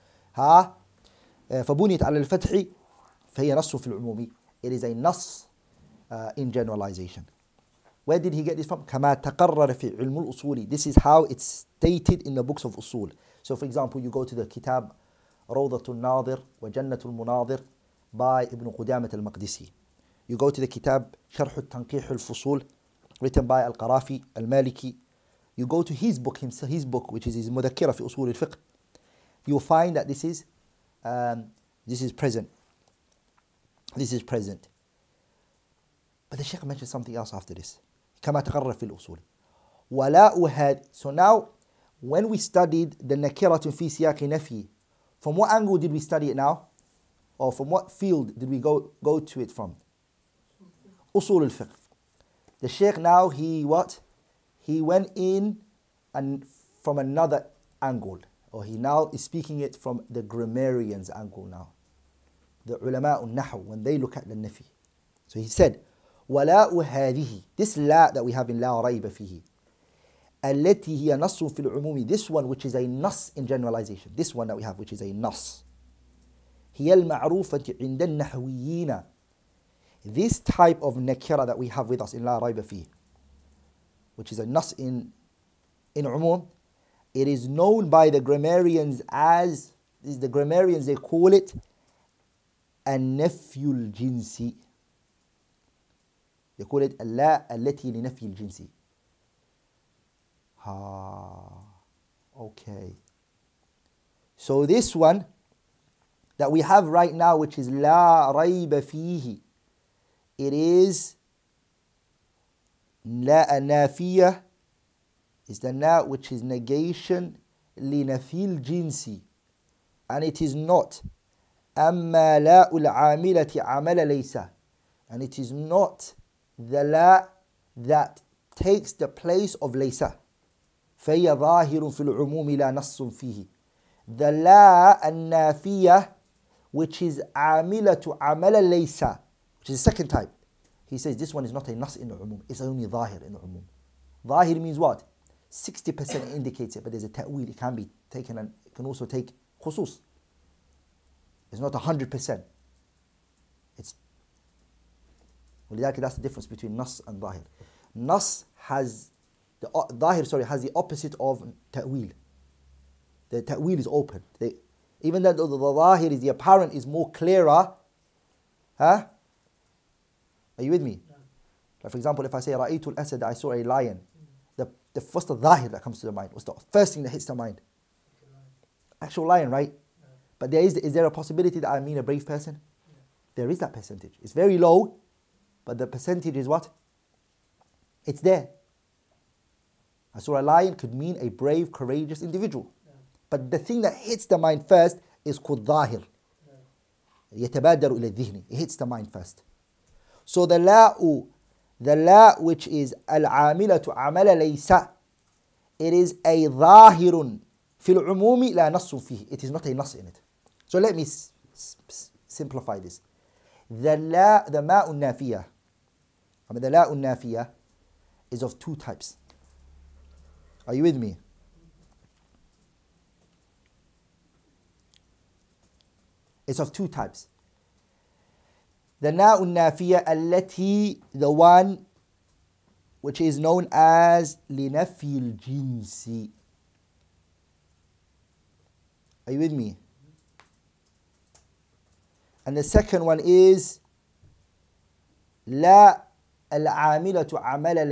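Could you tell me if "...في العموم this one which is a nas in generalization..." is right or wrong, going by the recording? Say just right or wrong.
right.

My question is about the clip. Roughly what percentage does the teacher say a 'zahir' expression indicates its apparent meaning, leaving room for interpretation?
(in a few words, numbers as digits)
60%.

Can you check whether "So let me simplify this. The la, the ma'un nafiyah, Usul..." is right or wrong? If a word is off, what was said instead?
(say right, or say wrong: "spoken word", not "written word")
wrong: "Abdallah", not "Usul".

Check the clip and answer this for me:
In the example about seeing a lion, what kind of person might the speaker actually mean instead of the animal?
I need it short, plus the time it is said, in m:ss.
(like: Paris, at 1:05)
A brave person, at 3:01.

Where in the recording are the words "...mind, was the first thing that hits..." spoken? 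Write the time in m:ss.
2:56.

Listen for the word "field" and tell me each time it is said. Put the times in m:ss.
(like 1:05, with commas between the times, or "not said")
0:47.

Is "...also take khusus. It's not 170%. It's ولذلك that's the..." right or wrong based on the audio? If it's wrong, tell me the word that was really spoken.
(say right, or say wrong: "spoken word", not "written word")
wrong: "100", not "170".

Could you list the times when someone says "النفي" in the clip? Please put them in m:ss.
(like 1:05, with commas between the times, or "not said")
1:32.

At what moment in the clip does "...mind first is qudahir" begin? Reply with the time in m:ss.
3:14.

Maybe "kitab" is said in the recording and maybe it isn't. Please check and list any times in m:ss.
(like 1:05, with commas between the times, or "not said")
0:14, 0:20.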